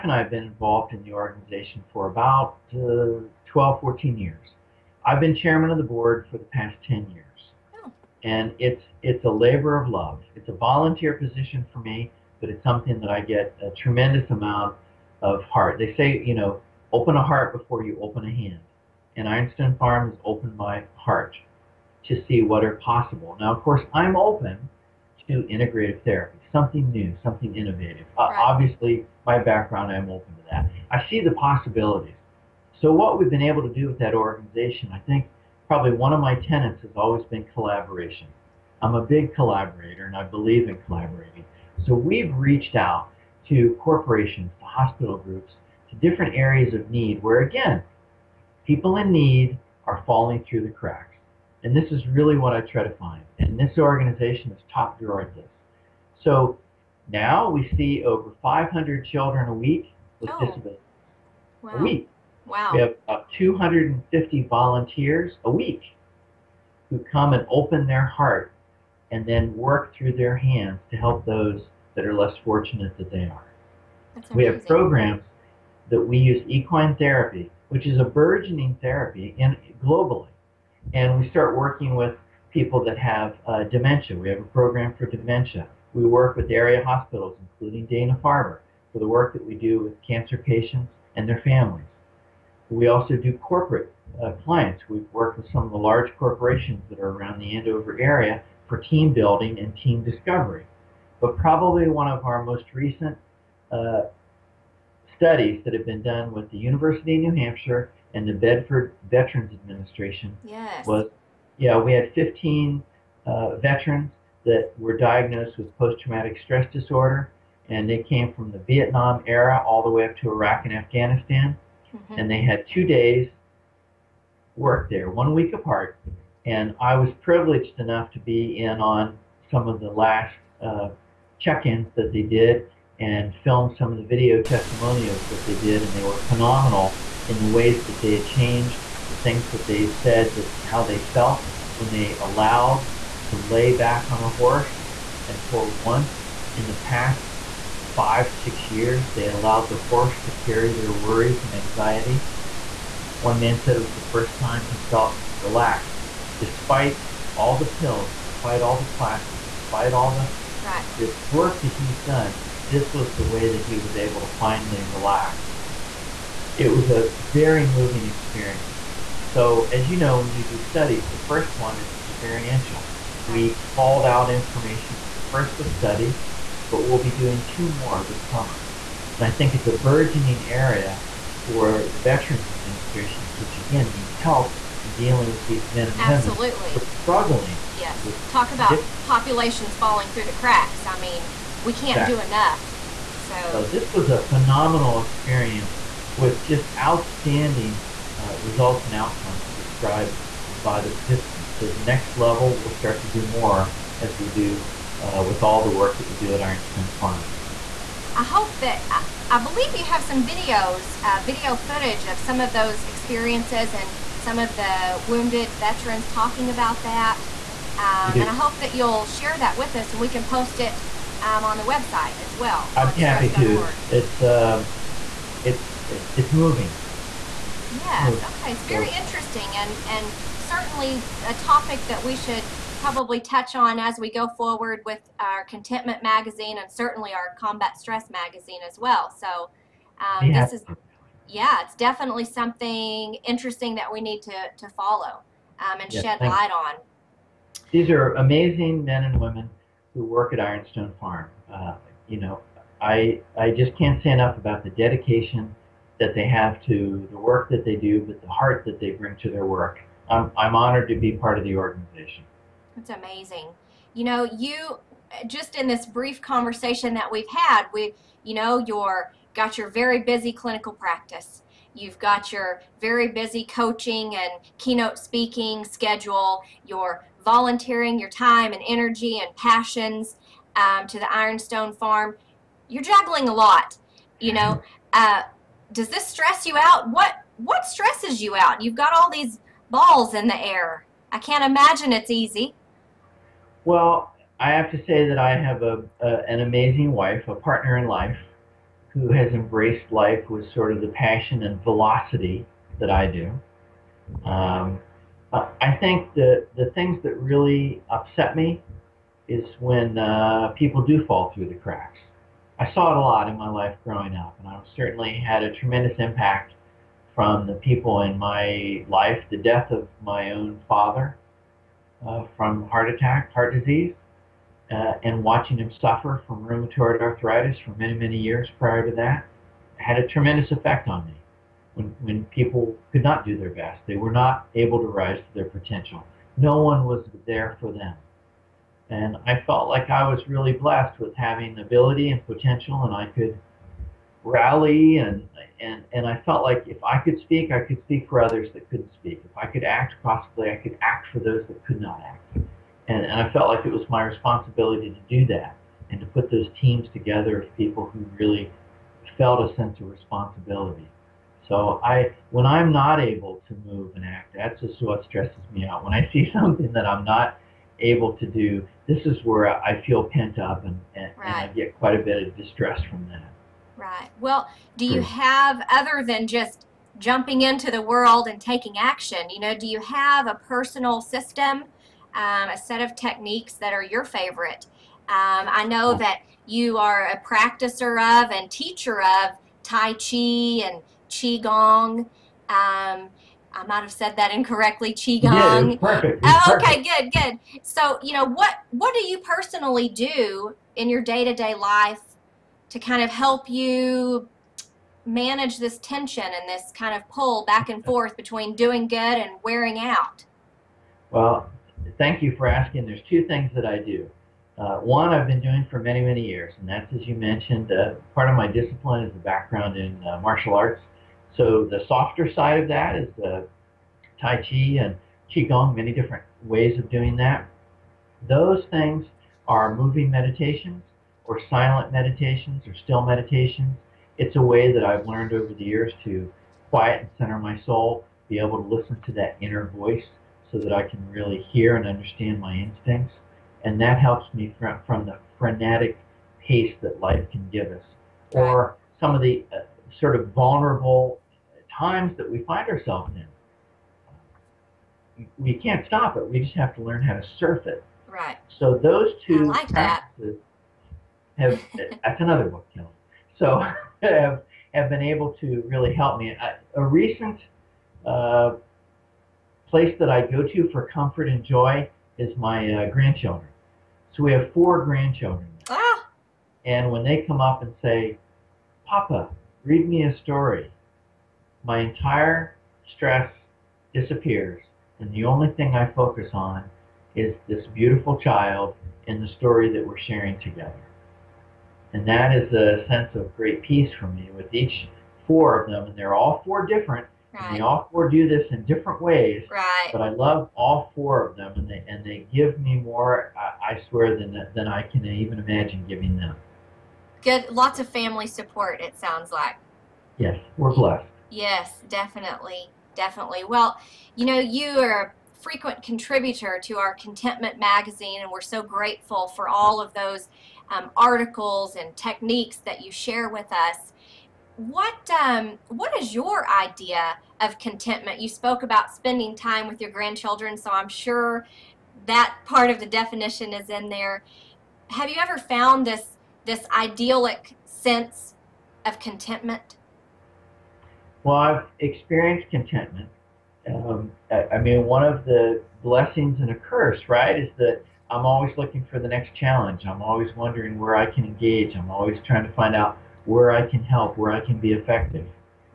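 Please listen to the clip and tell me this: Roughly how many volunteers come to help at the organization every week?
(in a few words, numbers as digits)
250.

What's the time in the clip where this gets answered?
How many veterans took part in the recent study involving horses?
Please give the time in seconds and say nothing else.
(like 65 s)
112 s.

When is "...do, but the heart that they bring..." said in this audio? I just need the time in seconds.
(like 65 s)
257 s.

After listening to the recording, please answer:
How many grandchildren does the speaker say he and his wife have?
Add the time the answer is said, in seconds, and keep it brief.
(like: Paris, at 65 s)
4, at 474 s.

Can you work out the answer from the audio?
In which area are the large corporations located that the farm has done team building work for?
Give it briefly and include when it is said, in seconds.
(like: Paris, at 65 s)
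Andover, at 97 s.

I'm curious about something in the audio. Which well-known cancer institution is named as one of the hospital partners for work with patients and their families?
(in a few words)
Dana Farber.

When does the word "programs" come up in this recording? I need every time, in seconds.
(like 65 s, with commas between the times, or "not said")
74 s, 84 s.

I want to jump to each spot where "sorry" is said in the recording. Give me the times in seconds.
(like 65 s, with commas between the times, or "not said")
not said.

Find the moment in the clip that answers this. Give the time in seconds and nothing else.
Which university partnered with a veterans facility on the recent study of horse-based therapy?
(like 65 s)
106 s.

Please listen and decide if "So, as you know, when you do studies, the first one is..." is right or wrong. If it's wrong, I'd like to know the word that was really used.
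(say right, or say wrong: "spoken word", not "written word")
right.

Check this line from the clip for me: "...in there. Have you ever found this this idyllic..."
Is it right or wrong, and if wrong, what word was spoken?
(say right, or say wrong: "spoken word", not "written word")
right.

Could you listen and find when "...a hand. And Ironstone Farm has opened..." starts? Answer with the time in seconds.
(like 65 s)
18 s.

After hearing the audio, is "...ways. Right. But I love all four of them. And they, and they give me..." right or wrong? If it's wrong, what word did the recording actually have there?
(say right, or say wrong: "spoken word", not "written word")
right.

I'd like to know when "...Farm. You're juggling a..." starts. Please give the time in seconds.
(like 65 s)
281 s.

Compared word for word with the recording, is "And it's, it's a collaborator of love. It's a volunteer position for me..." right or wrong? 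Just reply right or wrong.
wrong.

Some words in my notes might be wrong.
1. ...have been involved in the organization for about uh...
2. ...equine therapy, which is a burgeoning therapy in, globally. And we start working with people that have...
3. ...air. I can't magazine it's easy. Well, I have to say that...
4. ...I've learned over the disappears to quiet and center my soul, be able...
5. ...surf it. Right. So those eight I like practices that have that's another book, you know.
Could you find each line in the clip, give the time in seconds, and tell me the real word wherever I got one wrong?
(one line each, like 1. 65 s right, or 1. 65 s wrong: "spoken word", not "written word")
1. 0 s right
2. 76 s right
3. 290 s wrong: "imagine", not "magazine"
4. 434 s wrong: "years", not "disappears"
5. 457 s wrong: "two", not "eight".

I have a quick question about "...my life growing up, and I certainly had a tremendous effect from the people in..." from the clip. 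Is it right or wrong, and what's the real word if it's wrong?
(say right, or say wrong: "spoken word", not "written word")
wrong: "impact", not "effect".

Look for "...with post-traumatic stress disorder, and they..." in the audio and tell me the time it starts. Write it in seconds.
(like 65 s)
115 s.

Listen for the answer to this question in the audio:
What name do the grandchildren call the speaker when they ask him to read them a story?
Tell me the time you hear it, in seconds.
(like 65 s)
478 s.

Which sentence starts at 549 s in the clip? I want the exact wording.
I'm always wondering where I can engage.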